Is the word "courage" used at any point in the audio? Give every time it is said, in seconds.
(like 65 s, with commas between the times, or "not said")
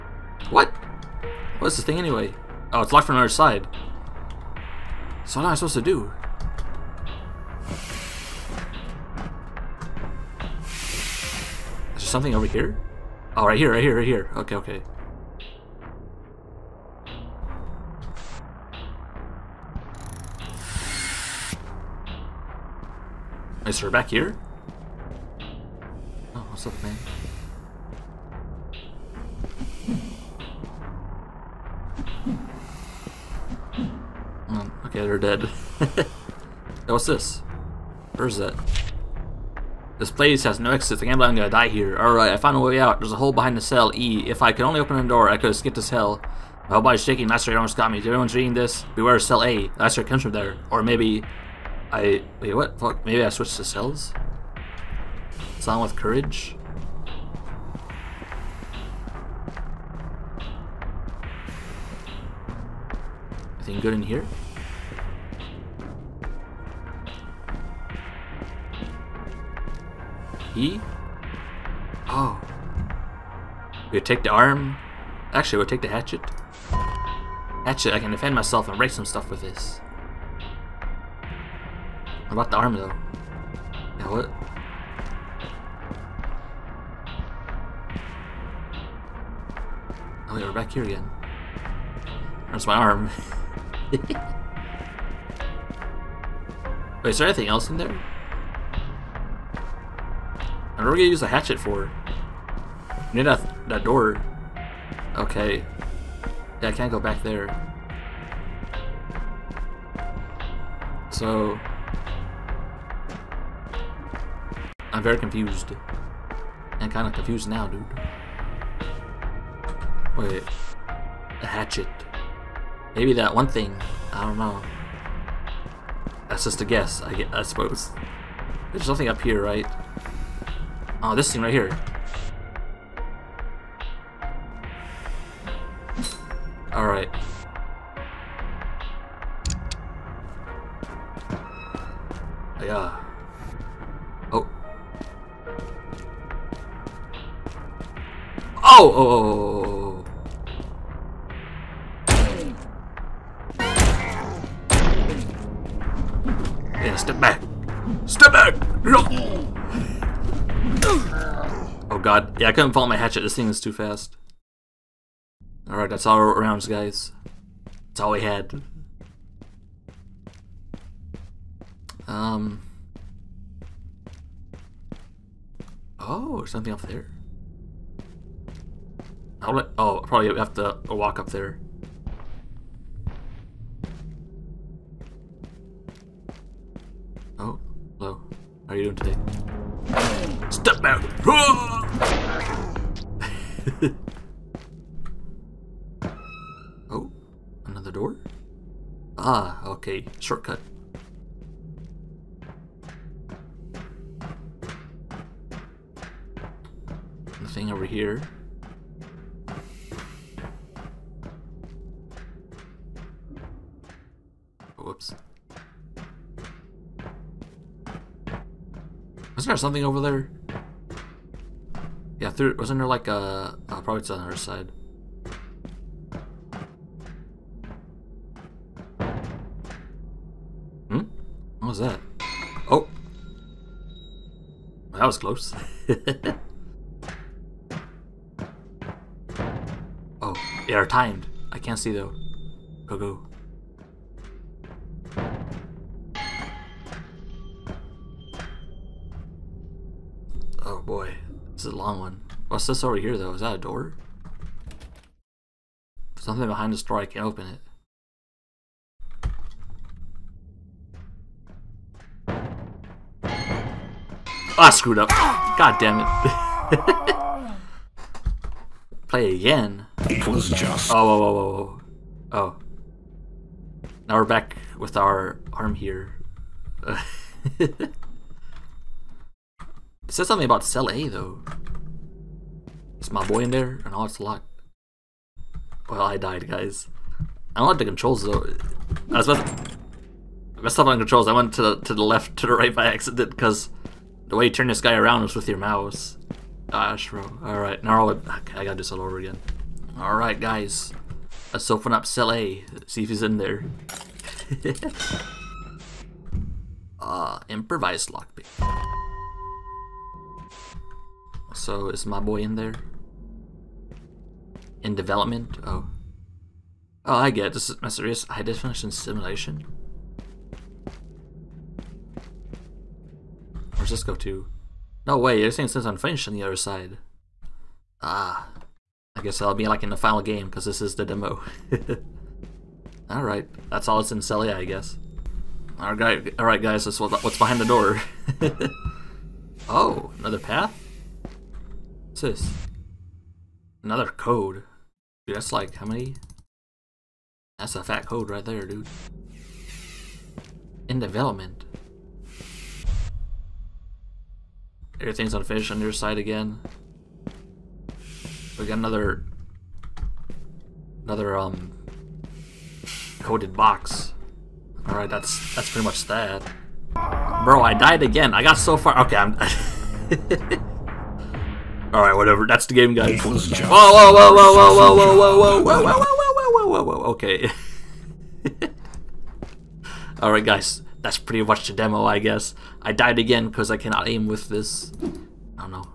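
55 s.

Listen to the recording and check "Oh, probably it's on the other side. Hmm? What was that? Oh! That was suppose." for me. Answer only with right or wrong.
wrong.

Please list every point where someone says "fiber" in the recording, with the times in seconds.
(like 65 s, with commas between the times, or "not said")
not said.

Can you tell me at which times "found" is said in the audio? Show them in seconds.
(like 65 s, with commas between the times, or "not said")
42 s.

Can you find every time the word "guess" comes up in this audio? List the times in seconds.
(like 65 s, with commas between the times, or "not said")
126 s, 329 s, 334 s, 382 s.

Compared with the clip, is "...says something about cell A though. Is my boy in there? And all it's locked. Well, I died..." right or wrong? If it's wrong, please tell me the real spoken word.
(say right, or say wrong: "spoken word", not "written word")
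right.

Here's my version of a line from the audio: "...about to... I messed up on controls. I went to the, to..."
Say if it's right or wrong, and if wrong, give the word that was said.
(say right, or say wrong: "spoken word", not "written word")
right.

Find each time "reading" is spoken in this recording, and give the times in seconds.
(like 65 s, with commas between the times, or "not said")
48 s.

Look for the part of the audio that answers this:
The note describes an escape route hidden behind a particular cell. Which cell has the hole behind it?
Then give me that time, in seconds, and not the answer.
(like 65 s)
43 s.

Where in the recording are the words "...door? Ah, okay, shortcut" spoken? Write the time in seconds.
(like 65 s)
197 s.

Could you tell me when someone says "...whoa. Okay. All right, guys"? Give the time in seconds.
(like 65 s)
376 s.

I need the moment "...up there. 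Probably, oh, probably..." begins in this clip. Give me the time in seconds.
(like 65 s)
176 s.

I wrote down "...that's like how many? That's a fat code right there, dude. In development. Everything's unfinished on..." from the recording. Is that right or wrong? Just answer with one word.
right.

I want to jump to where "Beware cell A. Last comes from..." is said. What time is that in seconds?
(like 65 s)
48 s.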